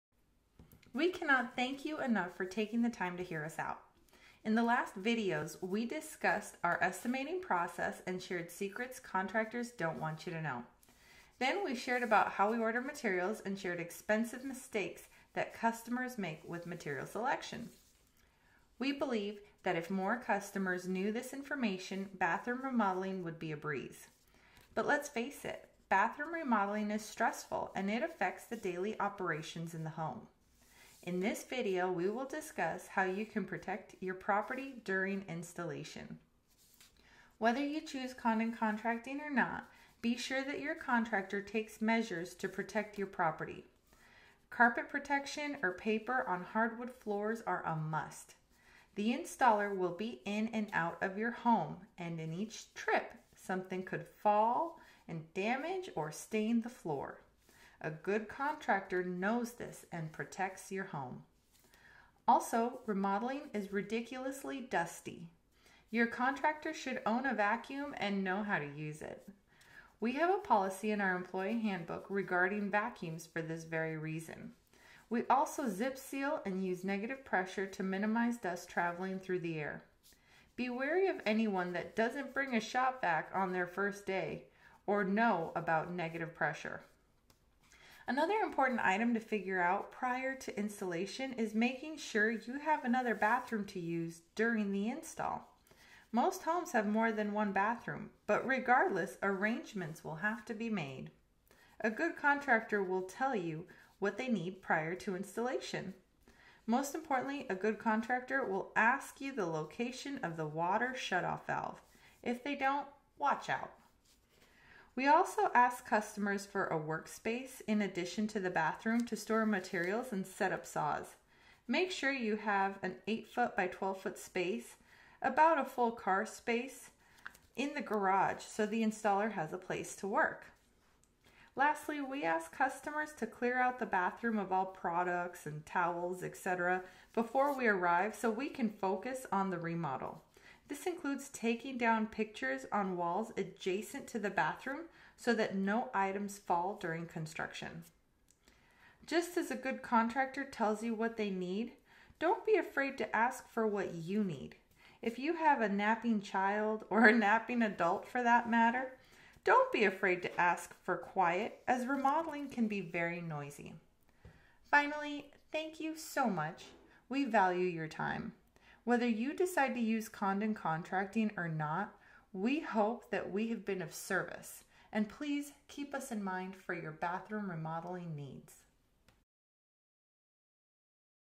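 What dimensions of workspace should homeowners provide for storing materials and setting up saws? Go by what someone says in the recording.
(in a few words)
8 feet by 12 feet.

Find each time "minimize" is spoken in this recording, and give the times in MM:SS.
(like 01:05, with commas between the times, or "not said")
01:17.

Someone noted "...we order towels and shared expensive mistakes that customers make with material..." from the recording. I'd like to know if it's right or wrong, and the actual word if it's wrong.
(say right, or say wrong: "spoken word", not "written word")
wrong: "materials", not "towels".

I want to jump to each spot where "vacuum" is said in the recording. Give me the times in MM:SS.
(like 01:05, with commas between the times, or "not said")
01:07, 01:12.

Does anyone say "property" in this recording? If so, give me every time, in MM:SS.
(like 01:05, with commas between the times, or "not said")
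00:34, 00:43.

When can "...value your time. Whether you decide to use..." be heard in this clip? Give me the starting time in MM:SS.
02:47.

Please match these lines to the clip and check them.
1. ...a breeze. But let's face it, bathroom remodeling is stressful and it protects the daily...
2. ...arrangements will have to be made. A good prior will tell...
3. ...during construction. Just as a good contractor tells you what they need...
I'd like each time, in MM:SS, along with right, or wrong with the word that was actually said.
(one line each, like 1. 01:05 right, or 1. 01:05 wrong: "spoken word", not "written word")
1. 00:23 wrong: "affects", not "protects"
2. 01:39 wrong: "contractor", not "prior"
3. 02:26 right.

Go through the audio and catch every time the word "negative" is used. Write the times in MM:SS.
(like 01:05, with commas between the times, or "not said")
01:16, 01:25.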